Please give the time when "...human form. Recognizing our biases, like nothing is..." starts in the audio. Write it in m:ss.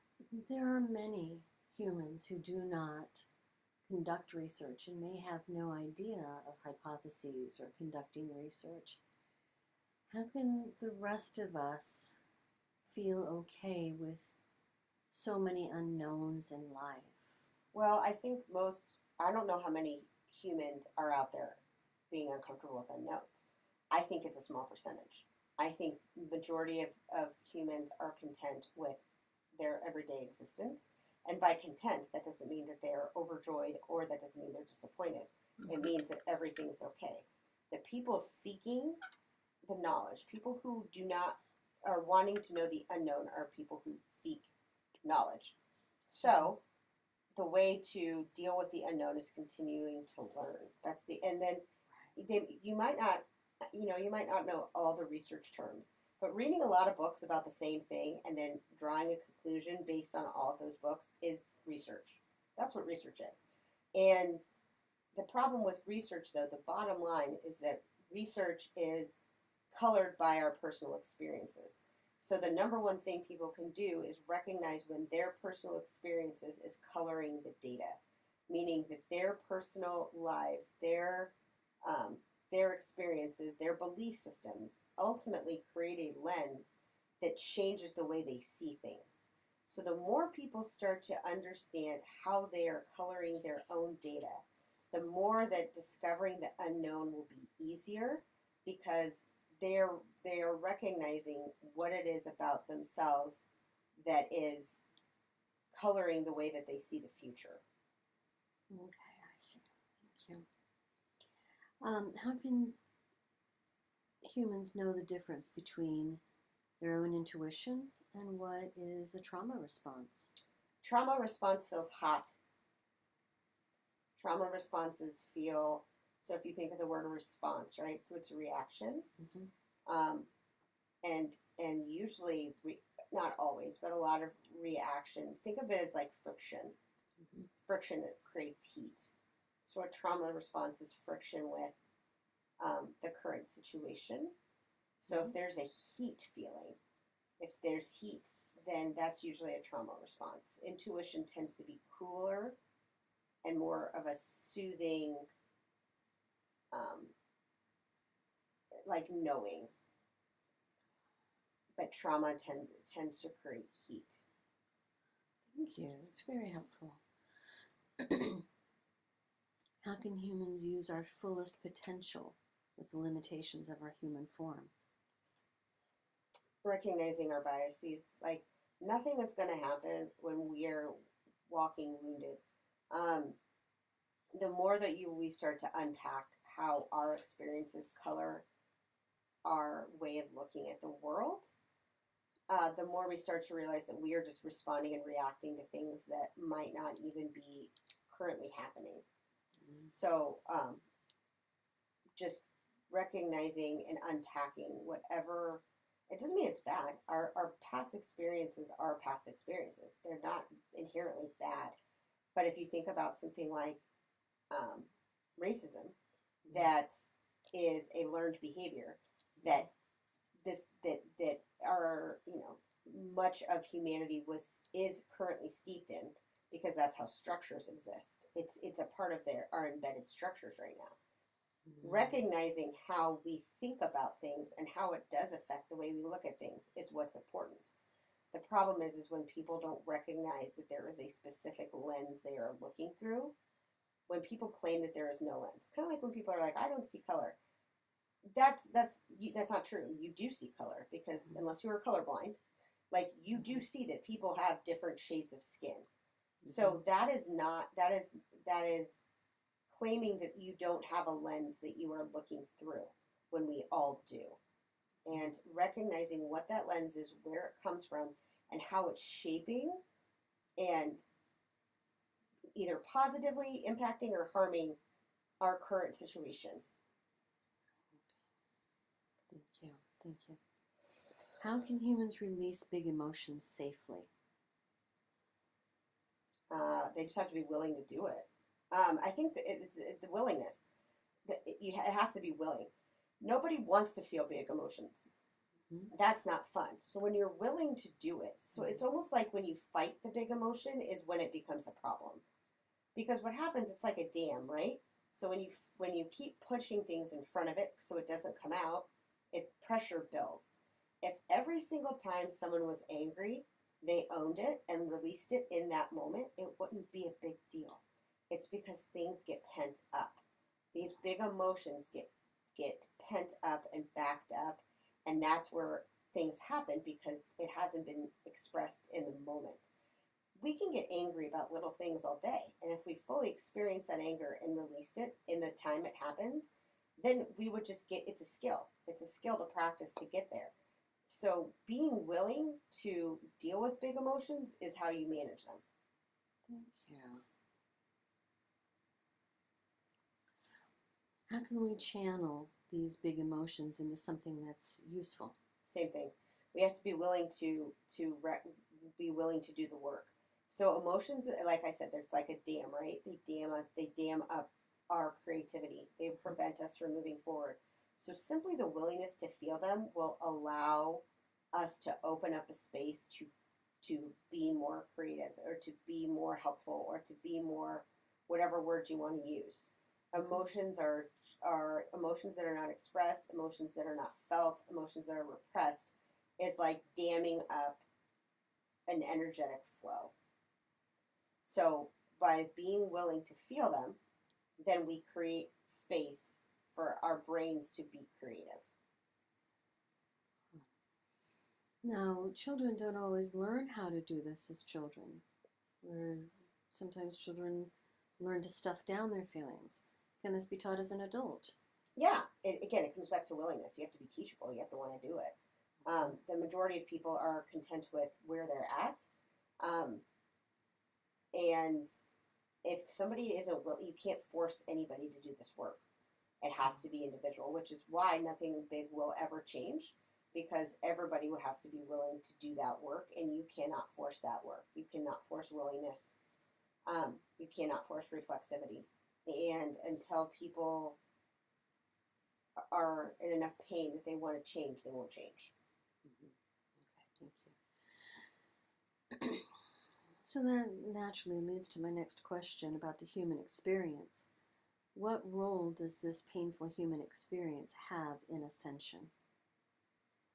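2:54.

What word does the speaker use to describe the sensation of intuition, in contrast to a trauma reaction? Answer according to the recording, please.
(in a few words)
cooler.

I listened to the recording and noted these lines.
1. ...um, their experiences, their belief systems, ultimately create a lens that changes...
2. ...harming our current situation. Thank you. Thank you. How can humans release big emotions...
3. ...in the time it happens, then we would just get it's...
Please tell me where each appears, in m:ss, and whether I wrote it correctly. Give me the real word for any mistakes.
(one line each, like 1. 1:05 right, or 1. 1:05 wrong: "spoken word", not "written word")
1. 1:21 right
2. 4:34 right
3. 5:35 right.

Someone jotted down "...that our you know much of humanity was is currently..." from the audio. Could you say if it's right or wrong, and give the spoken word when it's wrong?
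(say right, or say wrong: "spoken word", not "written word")
right.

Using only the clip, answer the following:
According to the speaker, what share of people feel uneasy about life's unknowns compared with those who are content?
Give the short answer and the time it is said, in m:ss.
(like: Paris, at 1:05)
a small percentage, at 0:24.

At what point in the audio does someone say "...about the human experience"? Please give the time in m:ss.
7:32.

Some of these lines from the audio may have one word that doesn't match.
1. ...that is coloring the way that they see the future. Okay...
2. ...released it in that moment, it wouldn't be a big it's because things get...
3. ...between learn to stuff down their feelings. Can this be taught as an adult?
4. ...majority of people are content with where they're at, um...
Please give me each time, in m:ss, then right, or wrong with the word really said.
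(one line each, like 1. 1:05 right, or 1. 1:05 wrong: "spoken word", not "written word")
1. 1:44 right
2. 5:14 right
3. 6:47 wrong: "children", not "between"
4. 6:56 right.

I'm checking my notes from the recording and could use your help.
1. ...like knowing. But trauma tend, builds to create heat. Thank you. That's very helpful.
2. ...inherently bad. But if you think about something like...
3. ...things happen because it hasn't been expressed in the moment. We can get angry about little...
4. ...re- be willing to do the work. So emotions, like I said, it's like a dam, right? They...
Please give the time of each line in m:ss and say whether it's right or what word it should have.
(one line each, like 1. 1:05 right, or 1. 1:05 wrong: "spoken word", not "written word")
1. 2:38 wrong: "tends", not "builds"
2. 3:30 right
3. 5:26 right
4. 5:58 right.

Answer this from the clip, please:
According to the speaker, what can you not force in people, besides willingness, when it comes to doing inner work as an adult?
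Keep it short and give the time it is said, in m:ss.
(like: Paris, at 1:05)
reflexivity, at 7:18.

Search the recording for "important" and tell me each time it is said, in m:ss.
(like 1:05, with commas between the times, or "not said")
3:57.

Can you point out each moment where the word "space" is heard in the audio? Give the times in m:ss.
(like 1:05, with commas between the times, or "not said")
6:12, 6:35.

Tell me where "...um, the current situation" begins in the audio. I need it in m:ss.
2:22.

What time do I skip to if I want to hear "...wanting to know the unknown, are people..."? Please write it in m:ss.
0:42.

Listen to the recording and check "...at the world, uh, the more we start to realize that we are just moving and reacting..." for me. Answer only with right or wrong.
wrong.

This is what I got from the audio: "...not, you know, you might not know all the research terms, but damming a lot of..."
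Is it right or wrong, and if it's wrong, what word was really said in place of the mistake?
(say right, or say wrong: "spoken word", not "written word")
wrong: "reading", not "damming".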